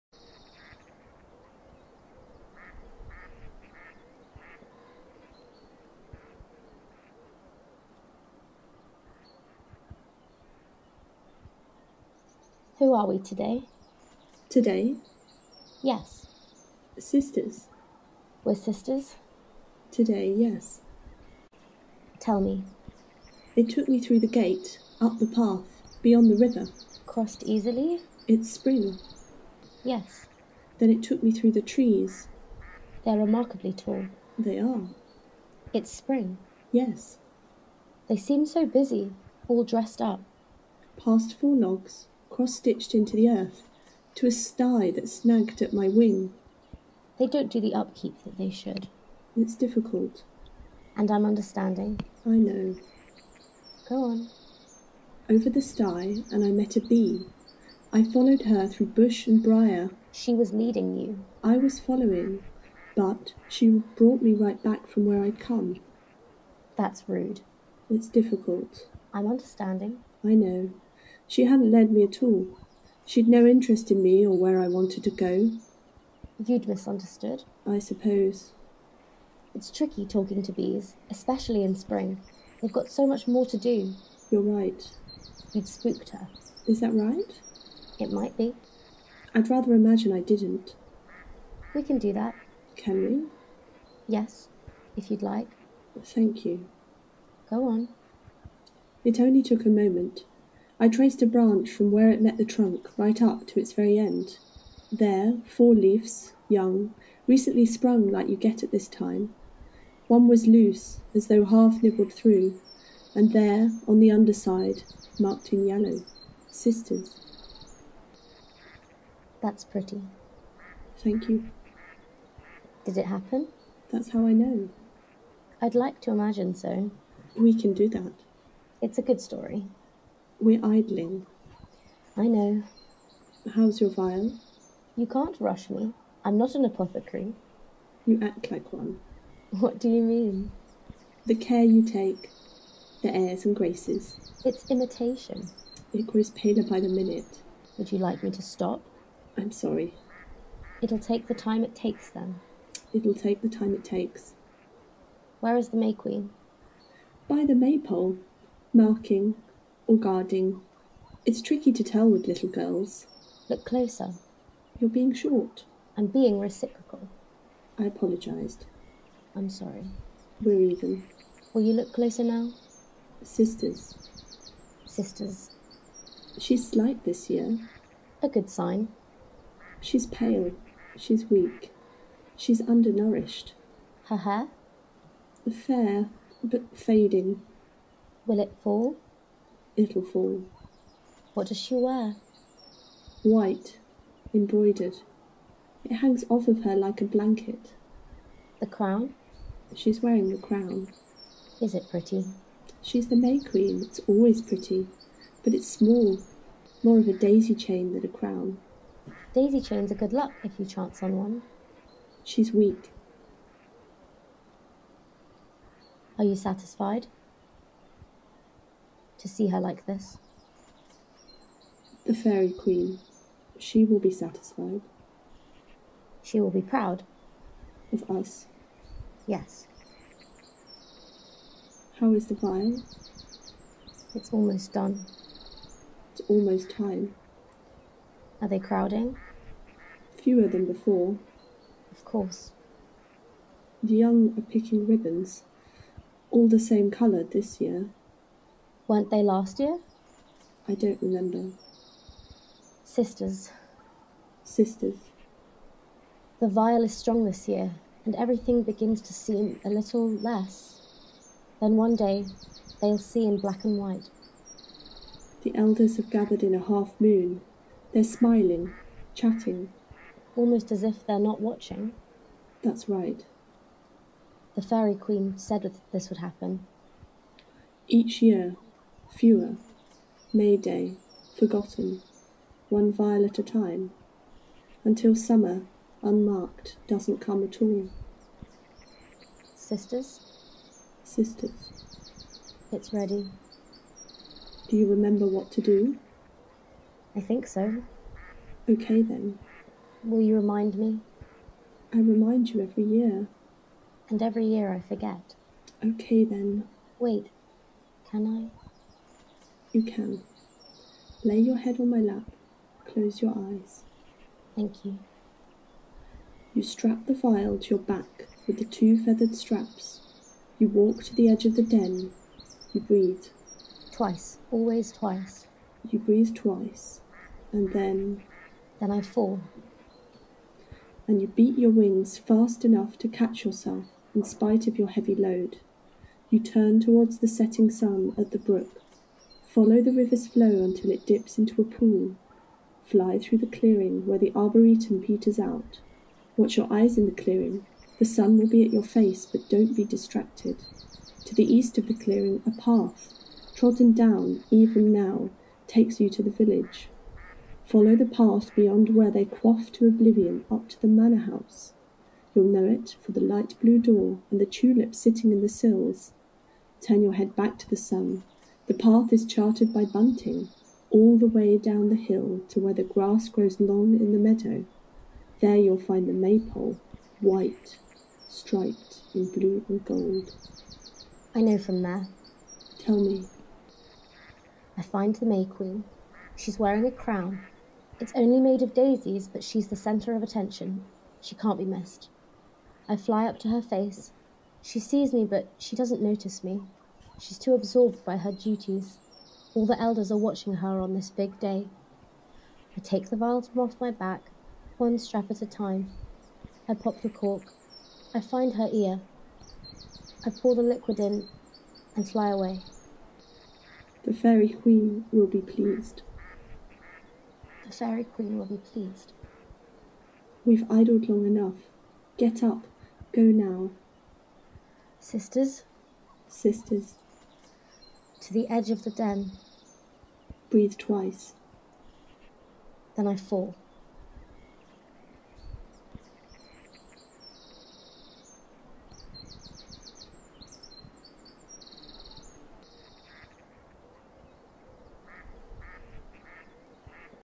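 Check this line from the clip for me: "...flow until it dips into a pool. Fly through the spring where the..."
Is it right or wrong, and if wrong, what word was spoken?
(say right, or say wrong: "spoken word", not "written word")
wrong: "clearing", not "spring".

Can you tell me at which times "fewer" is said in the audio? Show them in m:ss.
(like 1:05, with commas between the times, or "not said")
4:00, 4:39.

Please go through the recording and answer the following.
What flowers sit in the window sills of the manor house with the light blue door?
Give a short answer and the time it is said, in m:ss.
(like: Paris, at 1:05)
Tulips, at 6:04.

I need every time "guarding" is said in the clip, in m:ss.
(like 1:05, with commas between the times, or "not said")
2:39.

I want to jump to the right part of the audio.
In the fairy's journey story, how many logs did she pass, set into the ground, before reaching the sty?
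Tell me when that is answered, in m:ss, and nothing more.
0:41.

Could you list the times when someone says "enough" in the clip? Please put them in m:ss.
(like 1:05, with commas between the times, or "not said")
5:32, 7:01.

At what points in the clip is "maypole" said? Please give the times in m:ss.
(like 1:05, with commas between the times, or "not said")
2:37, 6:16.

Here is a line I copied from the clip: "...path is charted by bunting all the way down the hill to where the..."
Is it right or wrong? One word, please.
right.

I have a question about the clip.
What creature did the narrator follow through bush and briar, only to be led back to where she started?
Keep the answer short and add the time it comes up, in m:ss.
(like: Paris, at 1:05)
A bee, at 0:56.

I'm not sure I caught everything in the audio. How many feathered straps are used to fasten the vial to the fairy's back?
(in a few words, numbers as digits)
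2.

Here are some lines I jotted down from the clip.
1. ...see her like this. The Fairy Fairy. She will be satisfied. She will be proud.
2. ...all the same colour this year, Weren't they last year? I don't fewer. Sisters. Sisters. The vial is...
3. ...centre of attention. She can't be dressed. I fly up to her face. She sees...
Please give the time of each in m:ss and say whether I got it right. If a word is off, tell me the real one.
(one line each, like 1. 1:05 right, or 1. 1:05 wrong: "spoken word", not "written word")
1. 3:39 wrong: "Queen", not "Fairy"
2. 4:06 wrong: "remember", not "fewer"
3. 6:29 wrong: "missed", not "dressed".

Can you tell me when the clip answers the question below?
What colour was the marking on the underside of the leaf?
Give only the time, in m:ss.
1:55.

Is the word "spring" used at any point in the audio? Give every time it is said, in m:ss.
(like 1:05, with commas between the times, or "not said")
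0:28, 0:35, 1:21.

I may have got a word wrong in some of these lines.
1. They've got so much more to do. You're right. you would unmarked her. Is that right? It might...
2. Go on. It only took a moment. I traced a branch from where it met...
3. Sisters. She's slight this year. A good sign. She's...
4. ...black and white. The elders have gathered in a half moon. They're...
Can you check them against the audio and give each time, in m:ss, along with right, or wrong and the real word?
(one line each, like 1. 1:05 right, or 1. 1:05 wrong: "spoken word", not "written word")
1. 1:22 wrong: "spooked", not "unmarked"
2. 1:37 right
3. 2:54 right
4. 4:23 right.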